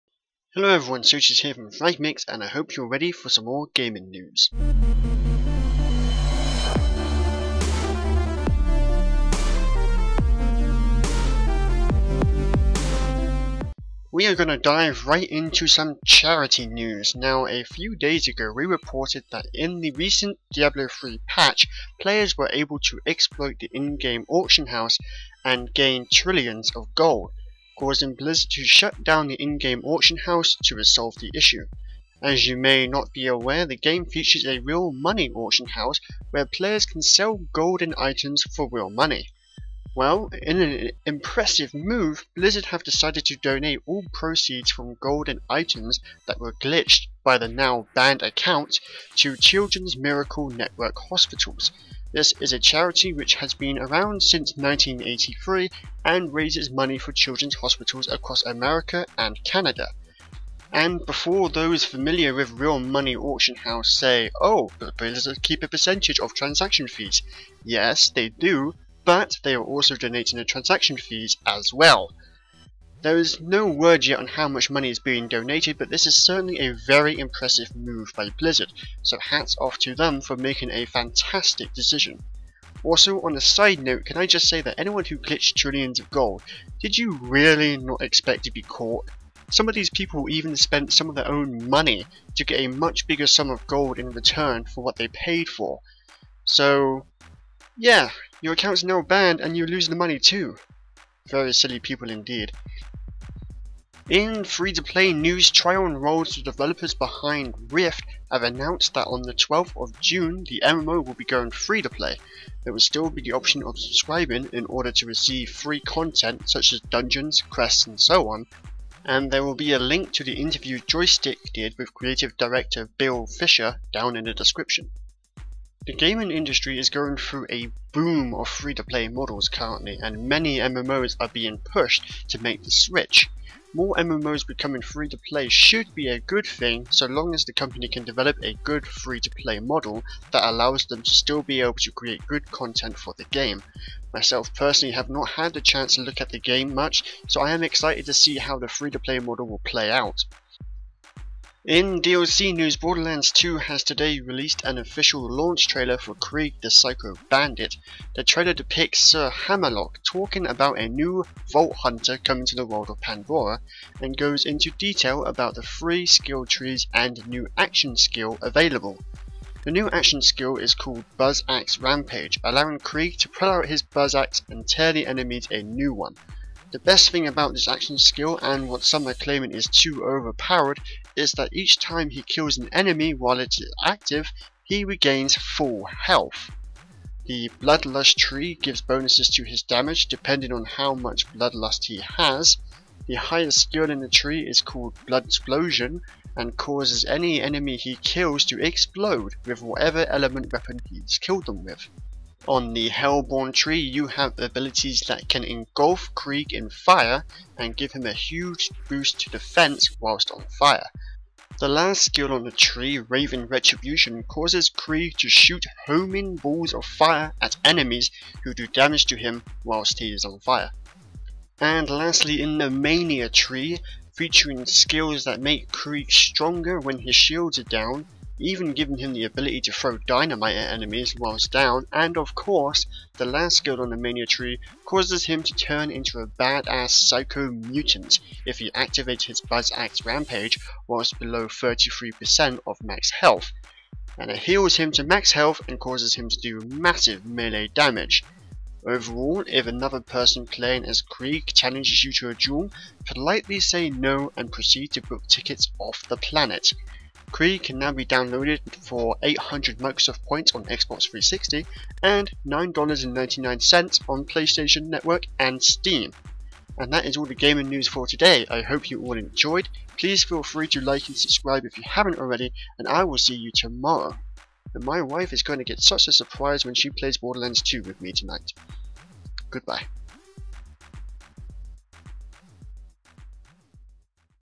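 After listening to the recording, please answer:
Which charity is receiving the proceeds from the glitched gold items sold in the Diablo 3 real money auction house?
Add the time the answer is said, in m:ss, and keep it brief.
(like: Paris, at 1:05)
Children's Miracle Network, at 0:49.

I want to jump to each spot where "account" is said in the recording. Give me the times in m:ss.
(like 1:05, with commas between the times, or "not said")
0:48, 1:38.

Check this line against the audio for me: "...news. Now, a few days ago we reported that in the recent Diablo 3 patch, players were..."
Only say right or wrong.
right.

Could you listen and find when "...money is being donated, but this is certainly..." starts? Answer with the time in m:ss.
1:14.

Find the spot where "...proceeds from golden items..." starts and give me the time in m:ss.
0:44.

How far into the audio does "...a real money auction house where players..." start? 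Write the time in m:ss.
0:34.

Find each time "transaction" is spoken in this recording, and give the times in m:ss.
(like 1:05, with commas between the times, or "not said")
1:06, 1:10.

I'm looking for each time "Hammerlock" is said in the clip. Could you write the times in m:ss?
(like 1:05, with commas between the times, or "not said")
2:39.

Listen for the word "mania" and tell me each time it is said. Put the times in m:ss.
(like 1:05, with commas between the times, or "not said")
3:42, 3:53.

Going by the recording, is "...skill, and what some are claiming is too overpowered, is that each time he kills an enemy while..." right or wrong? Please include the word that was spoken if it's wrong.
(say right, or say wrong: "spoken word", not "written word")
right.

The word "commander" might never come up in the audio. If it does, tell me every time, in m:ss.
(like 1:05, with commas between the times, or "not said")
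not said.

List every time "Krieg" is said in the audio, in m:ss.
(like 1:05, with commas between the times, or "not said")
2:36, 2:52, 3:26, 3:34, 3:45, 4:11, 4:17.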